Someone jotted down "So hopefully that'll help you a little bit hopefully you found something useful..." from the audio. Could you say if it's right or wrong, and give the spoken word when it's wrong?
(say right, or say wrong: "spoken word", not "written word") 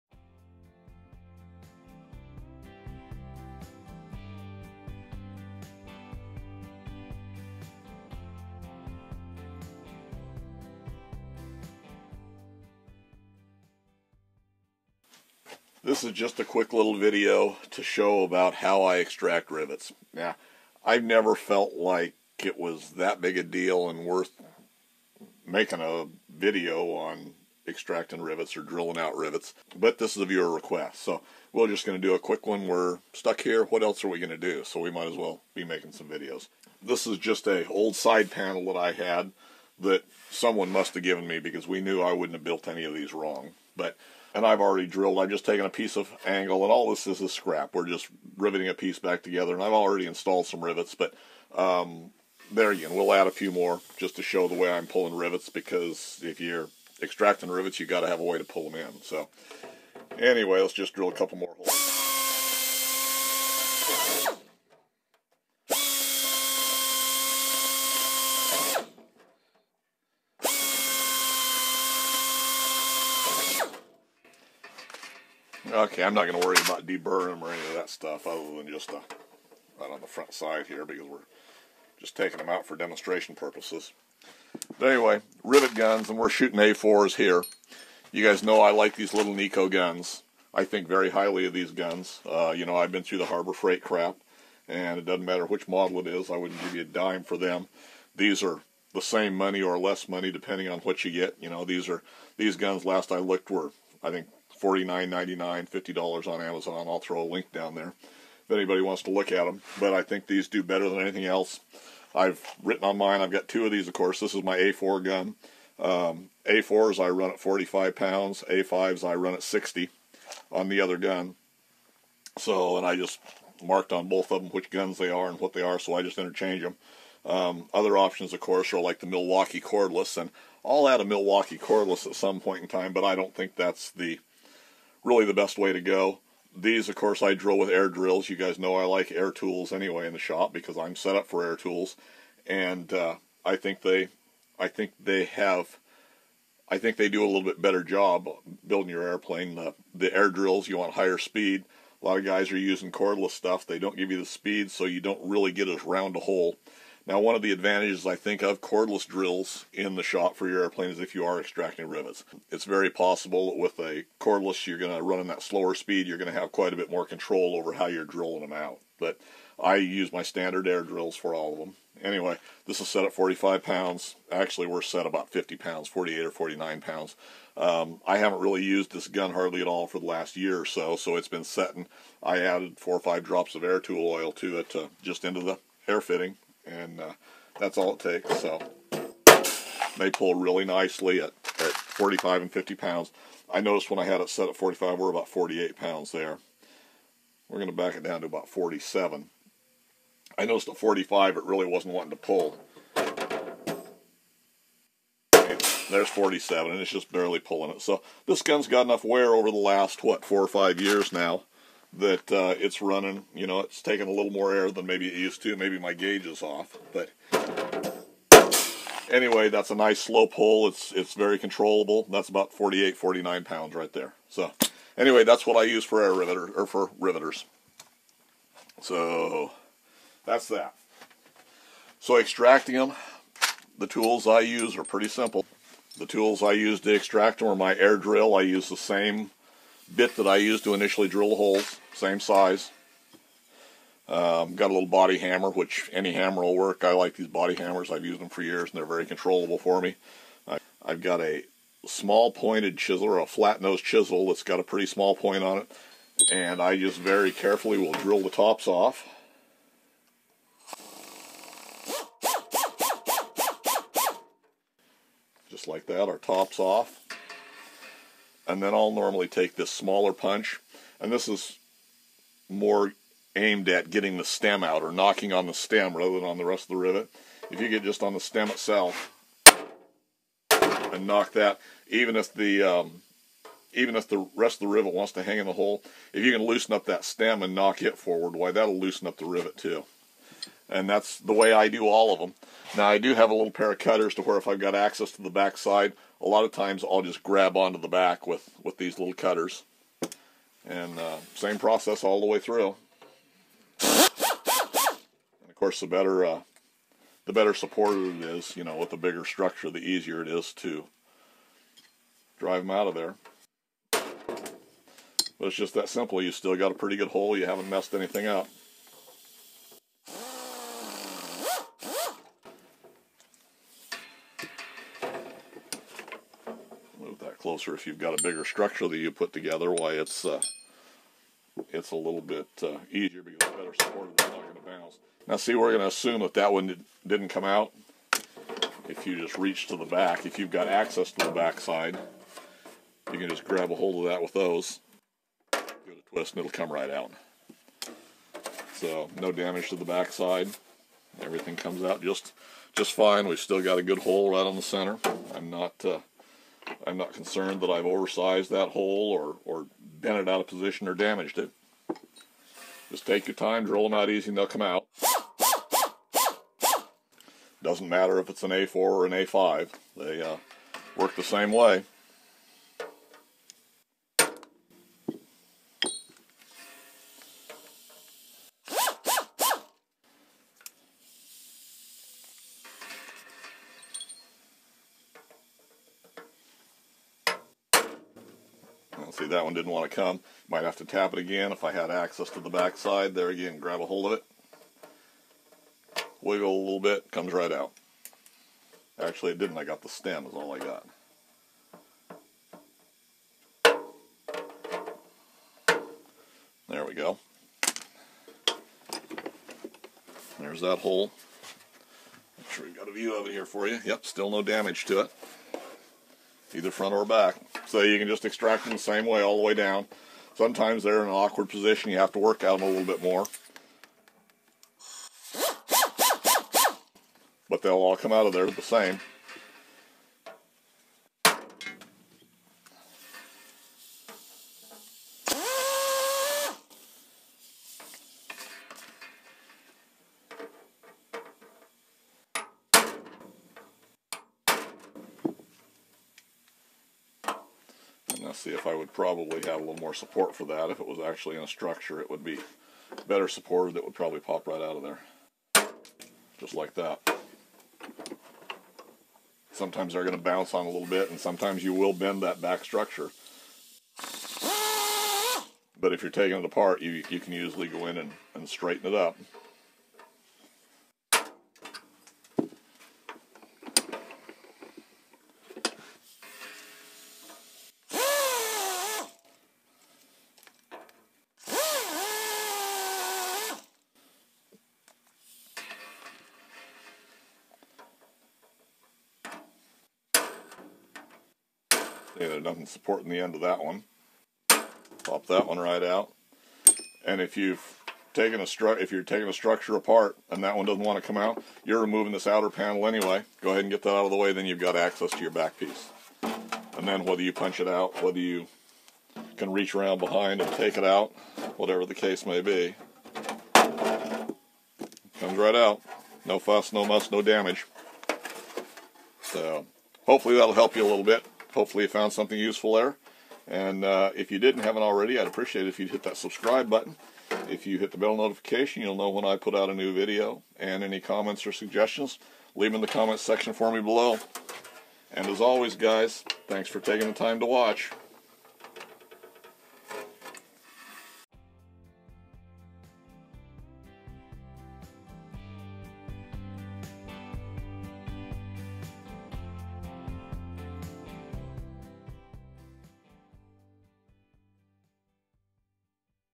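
right.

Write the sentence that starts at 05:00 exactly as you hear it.
And uh, same process all the way through.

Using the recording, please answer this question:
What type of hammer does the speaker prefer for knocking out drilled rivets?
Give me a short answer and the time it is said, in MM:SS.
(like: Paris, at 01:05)
body hammer, at 04:04.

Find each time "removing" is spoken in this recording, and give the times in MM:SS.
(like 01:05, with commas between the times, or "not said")
08:21.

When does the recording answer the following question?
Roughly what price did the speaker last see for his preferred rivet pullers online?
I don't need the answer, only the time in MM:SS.
01:44.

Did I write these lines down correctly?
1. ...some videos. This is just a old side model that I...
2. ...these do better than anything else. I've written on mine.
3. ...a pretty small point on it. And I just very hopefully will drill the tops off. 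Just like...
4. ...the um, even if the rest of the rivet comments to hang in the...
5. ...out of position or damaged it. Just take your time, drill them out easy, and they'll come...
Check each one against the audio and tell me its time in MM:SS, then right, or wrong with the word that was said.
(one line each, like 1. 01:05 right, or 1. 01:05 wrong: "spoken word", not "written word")
1. 00:35 wrong: "panel", not "model"
2. 01:50 right
3. 04:14 wrong: "carefully", not "hopefully"
4. 04:42 wrong: "wants", not "comments"
5. 06:00 right.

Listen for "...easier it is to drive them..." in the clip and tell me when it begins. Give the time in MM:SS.
05:09.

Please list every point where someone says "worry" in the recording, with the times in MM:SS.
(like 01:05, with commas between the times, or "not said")
01:16.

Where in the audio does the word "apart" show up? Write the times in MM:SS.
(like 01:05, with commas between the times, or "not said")
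07:46, 08:19.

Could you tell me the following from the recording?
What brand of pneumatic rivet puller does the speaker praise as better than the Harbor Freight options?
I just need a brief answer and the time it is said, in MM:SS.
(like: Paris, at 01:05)
Neiko, at 01:29.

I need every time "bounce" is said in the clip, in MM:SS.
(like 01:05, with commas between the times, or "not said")
05:34, 07:40.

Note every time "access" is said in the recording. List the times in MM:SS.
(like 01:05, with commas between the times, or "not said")
04:54, 05:40, 06:31, 08:24.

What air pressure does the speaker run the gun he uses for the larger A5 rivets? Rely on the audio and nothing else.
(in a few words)
60 pounds.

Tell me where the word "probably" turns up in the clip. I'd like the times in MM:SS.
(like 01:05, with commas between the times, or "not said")
07:28, 07:33.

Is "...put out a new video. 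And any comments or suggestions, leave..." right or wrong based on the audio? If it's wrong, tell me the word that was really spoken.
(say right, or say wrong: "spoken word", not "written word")
right.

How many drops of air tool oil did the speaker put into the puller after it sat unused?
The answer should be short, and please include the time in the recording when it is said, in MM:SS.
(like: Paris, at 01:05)
4 or 5, at 03:02.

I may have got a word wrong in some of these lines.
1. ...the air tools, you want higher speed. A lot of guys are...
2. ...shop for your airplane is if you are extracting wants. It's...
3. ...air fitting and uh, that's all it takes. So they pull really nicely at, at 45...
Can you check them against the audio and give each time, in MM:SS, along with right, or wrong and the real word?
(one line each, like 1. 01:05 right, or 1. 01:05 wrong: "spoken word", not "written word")
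1. 02:29 wrong: "drills", not "tools"
2. 02:40 wrong: "rivets", not "wants"
3. 03:05 right.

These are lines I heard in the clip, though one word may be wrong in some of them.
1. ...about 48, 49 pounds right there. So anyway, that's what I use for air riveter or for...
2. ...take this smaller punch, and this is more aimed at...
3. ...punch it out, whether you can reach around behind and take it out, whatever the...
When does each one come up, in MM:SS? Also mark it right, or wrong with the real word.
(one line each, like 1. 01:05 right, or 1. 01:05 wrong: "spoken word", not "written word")
1. 03:42 right
2. 04:29 right
3. 08:27 right.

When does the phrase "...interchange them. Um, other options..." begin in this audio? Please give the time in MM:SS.
02:06.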